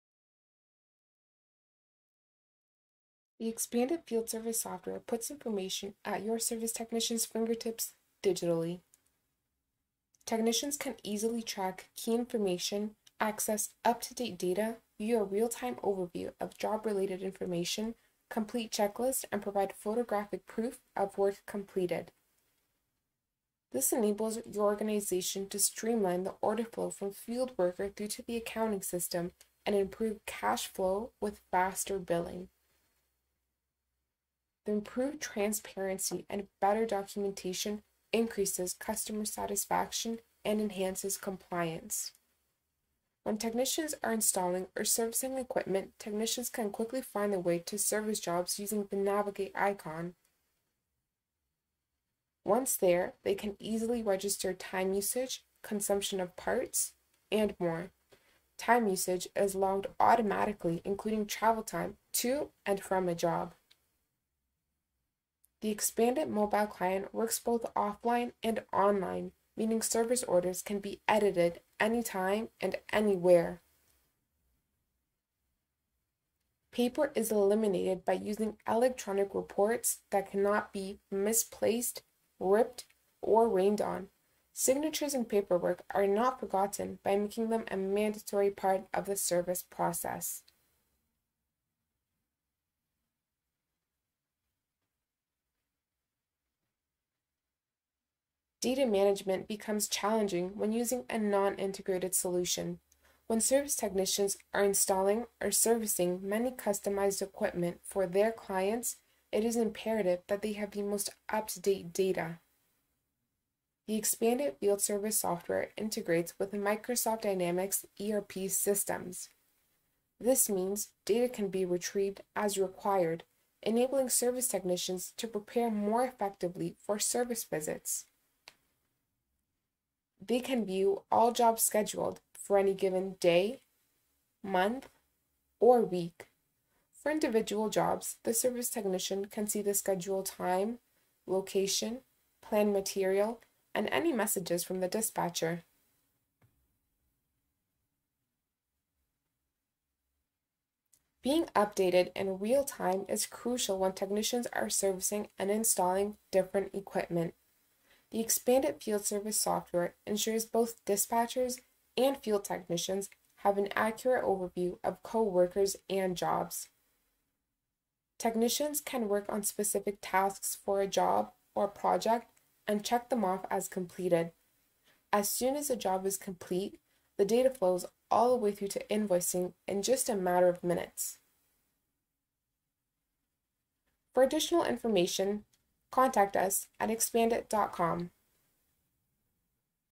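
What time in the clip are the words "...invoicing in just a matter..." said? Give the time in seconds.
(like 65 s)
178 s.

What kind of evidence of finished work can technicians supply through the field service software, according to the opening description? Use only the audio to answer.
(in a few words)
Photographic proof.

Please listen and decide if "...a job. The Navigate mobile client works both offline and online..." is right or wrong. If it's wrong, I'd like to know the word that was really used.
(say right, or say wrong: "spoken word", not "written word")
wrong: "ExpandIT", not "Navigate".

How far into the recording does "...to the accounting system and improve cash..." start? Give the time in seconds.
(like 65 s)
28 s.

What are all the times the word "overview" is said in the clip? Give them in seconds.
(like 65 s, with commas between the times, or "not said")
15 s, 164 s.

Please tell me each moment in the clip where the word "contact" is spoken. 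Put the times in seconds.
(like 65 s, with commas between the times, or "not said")
185 s.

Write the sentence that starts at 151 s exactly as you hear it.
Being updated in real time is crucial when technicians are servicing and installing different equipment.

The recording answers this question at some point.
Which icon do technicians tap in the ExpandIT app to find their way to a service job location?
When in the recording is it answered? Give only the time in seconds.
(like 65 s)
48 s.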